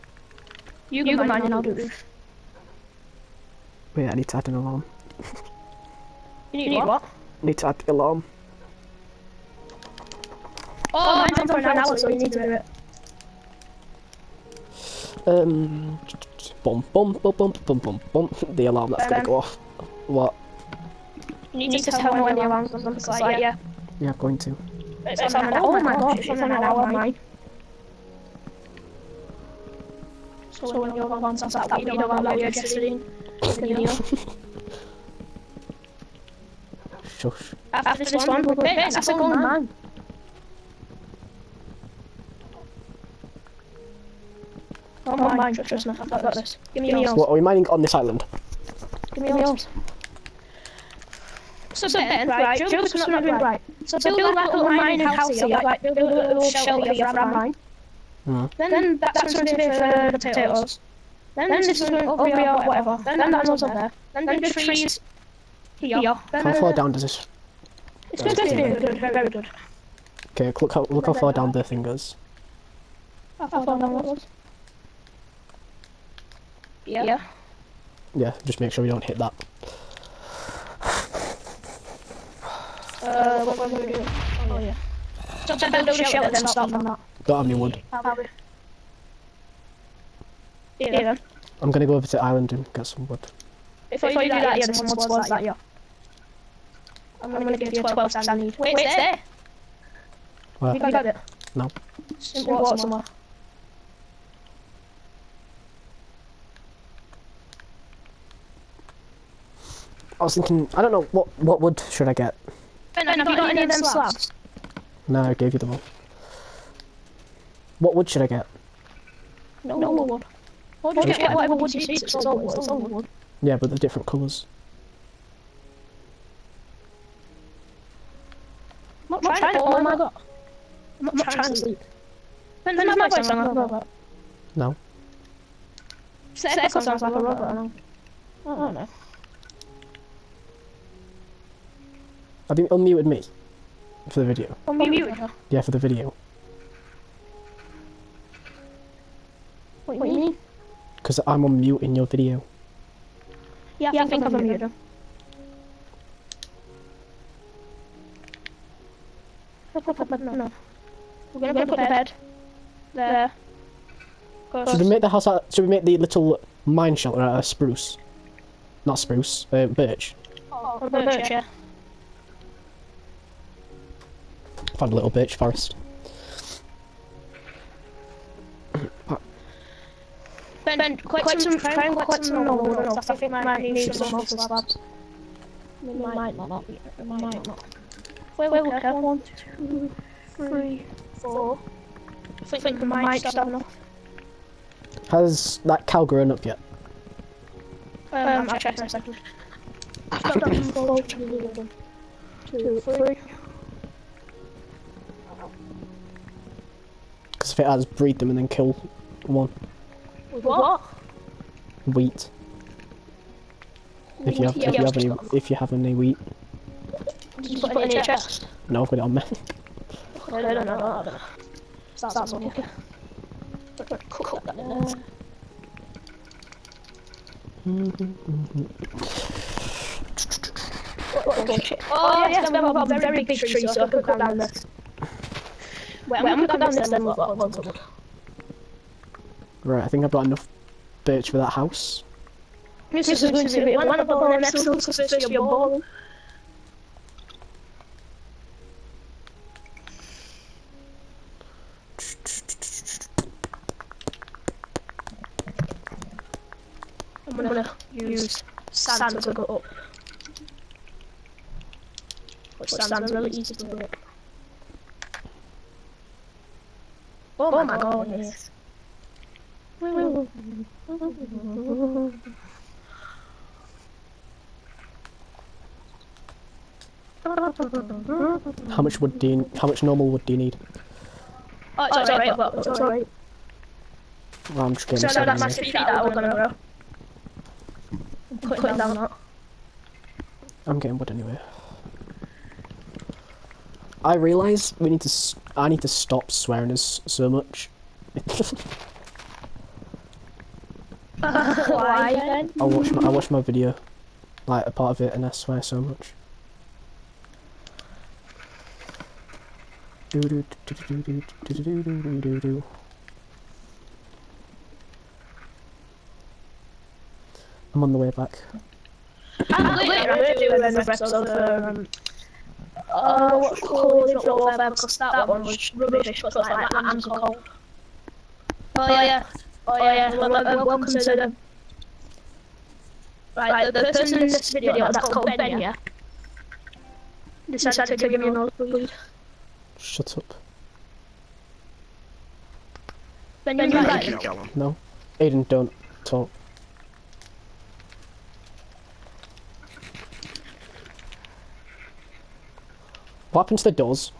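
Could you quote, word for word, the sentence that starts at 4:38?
How much wood do you, how much normal wood do you need?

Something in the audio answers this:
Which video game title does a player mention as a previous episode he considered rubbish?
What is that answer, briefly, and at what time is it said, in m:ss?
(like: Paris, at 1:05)
Call of Duty Warfare, at 5:23.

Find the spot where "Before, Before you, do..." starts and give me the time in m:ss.
1:33.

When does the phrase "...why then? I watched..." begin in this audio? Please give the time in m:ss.
5:01.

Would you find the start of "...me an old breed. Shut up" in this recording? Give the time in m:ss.
5:38.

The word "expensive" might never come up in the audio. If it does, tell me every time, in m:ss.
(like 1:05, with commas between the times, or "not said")
not said.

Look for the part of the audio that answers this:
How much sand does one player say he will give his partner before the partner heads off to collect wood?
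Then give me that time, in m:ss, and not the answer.
1:37.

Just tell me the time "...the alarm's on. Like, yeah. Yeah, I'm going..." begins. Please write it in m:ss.
0:22.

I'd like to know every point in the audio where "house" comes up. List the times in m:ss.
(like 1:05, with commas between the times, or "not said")
0:55, 2:45, 4:01.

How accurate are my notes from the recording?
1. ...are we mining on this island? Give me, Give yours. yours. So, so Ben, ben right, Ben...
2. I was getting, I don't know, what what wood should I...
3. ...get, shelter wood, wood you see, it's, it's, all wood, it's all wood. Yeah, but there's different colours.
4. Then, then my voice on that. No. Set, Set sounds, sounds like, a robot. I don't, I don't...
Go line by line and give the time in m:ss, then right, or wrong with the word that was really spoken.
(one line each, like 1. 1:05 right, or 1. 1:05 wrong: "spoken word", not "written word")
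1. 0:47 wrong: "Joe", not "Ben"
2. 1:50 wrong: "thinking", not "getting"
3. 2:01 wrong: "whatever", not "shelter"
4. 2:12 right.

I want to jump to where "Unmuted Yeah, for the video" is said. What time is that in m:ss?
2:24.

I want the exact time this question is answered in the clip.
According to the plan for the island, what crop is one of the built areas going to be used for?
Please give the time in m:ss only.
1:00.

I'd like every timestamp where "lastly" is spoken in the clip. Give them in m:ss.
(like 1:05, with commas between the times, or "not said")
not said.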